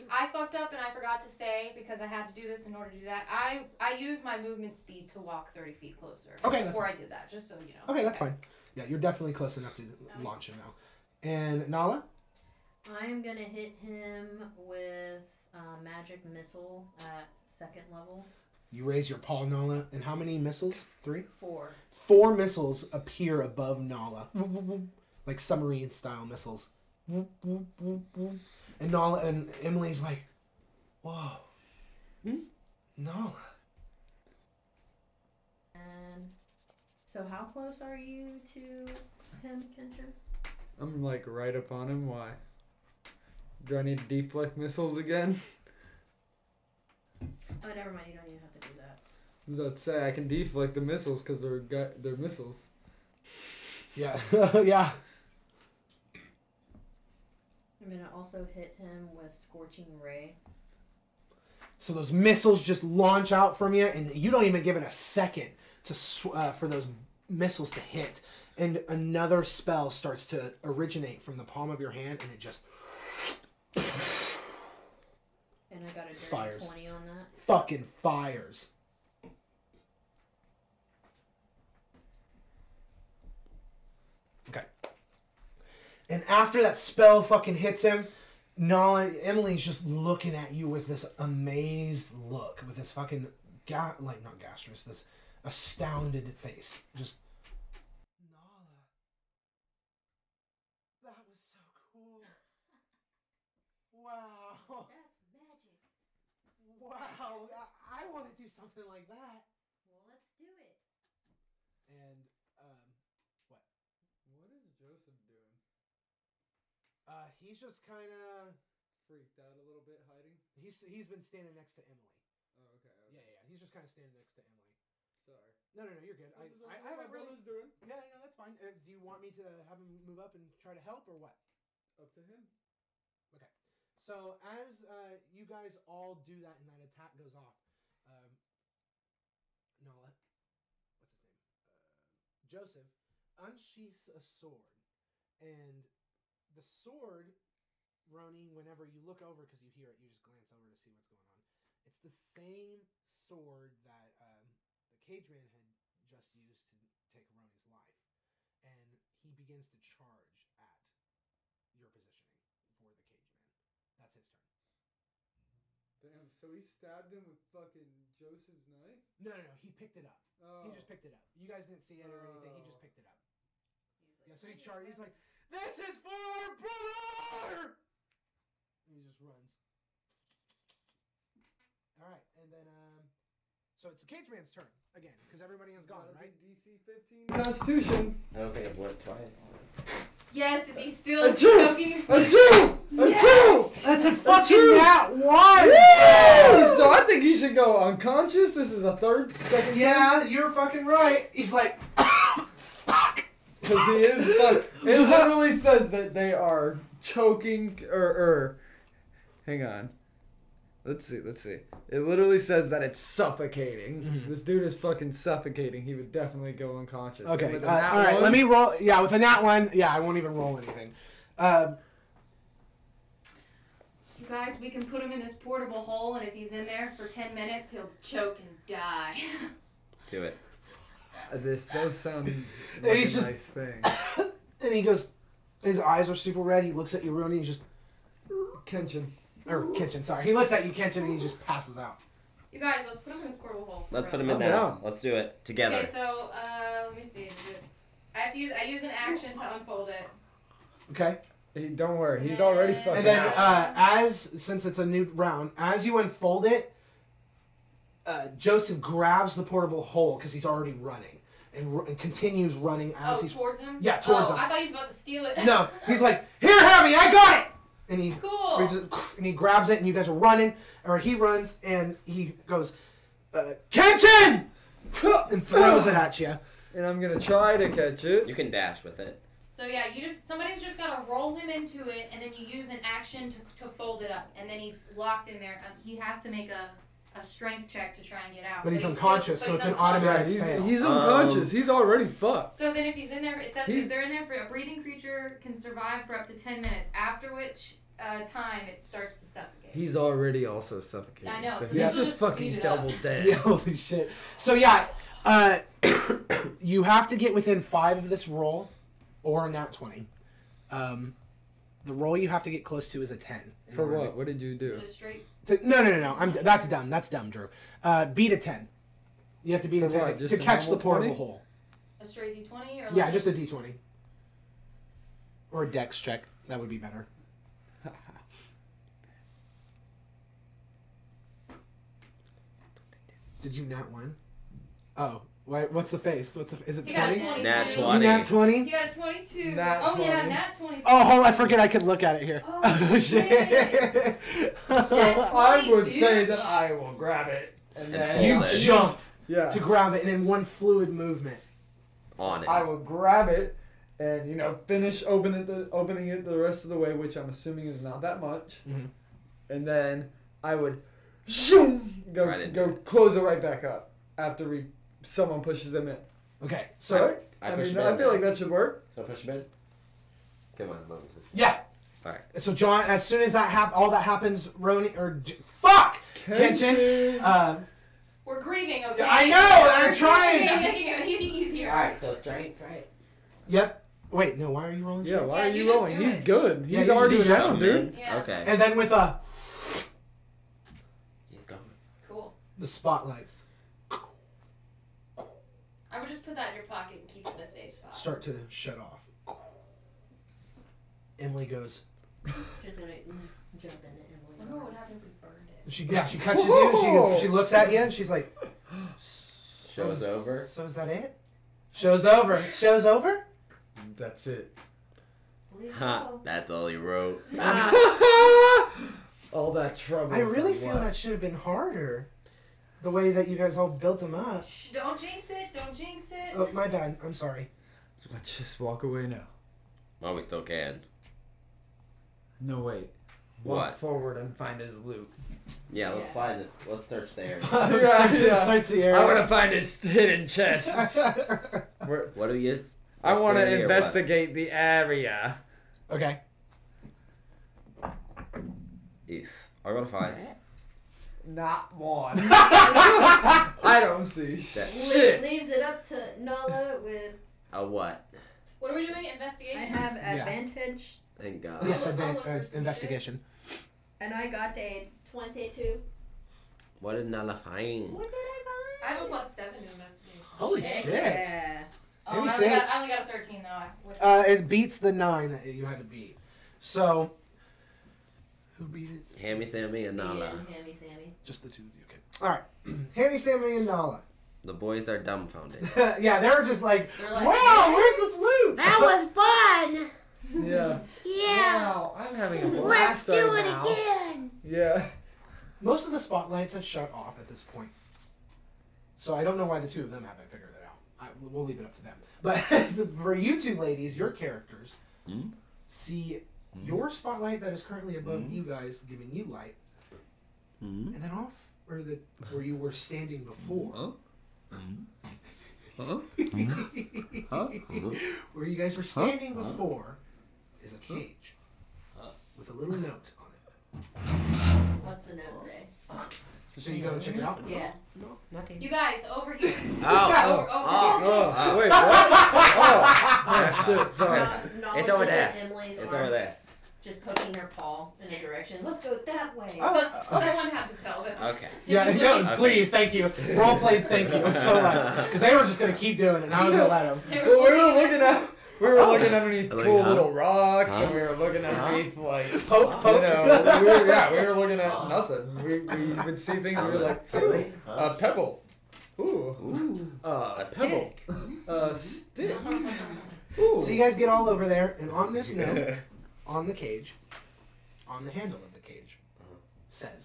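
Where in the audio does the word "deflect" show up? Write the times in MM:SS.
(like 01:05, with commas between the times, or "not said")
00:44, 00:50.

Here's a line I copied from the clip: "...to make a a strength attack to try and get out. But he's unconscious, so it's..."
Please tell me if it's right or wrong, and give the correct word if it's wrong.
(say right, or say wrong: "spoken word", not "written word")
wrong: "check", not "attack".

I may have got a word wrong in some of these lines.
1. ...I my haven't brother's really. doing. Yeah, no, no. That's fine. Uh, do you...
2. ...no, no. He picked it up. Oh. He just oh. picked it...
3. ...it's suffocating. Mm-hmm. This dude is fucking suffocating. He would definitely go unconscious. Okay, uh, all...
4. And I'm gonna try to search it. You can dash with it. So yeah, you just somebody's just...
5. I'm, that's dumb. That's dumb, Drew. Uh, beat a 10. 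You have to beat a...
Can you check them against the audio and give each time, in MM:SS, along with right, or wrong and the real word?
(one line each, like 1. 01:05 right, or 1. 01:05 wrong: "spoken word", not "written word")
1. 02:06 right
2. 02:49 right
3. 03:32 right
4. 04:36 wrong: "catch", not "search"
5. 05:16 right.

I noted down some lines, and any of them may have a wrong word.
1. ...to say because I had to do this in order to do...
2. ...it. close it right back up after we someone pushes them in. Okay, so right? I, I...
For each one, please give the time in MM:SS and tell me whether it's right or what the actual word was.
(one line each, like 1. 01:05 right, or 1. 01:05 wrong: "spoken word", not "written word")
1. 00:01 right
2. 06:02 right.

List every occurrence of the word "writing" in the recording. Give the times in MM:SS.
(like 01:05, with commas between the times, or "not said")
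not said.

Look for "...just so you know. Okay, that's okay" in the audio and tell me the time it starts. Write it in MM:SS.
00:07.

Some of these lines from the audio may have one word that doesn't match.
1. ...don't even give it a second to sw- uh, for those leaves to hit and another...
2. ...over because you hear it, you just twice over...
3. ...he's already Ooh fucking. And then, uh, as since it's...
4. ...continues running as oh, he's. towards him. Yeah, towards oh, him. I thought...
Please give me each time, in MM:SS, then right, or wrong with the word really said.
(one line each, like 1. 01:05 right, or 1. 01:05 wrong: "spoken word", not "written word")
1. 01:04 wrong: "missiles", not "leaves"
2. 02:29 wrong: "glance", not "twice"
3. 04:12 wrong: "And", not "Ooh"
4. 04:21 right.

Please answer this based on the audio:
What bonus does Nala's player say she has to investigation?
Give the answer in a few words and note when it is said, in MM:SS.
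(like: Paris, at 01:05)
+7, at 07:49.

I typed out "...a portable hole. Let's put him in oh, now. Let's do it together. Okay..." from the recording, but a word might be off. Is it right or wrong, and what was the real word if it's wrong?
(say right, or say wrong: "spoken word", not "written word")
right.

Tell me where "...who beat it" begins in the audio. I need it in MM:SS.
07:58.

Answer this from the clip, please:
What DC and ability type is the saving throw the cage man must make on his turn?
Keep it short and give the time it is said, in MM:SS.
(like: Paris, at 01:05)
DC 15 Constitution, at 03:06.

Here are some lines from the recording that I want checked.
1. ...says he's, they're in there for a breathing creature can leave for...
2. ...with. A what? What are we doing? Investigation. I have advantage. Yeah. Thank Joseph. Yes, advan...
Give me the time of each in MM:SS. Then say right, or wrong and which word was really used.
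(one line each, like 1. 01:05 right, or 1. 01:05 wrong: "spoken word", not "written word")
1. 04:53 wrong: "survive", not "leave"
2. 07:36 wrong: "God", not "Joseph".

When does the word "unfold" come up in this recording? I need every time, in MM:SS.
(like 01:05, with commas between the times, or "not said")
04:09, 04:15.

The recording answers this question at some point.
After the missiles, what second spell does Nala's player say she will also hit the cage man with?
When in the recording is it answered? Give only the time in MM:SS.
00:59.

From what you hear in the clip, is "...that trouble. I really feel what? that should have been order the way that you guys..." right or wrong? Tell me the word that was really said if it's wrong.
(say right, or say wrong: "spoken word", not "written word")
wrong: "harder", not "order".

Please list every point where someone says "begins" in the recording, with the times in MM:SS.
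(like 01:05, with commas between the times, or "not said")
02:39.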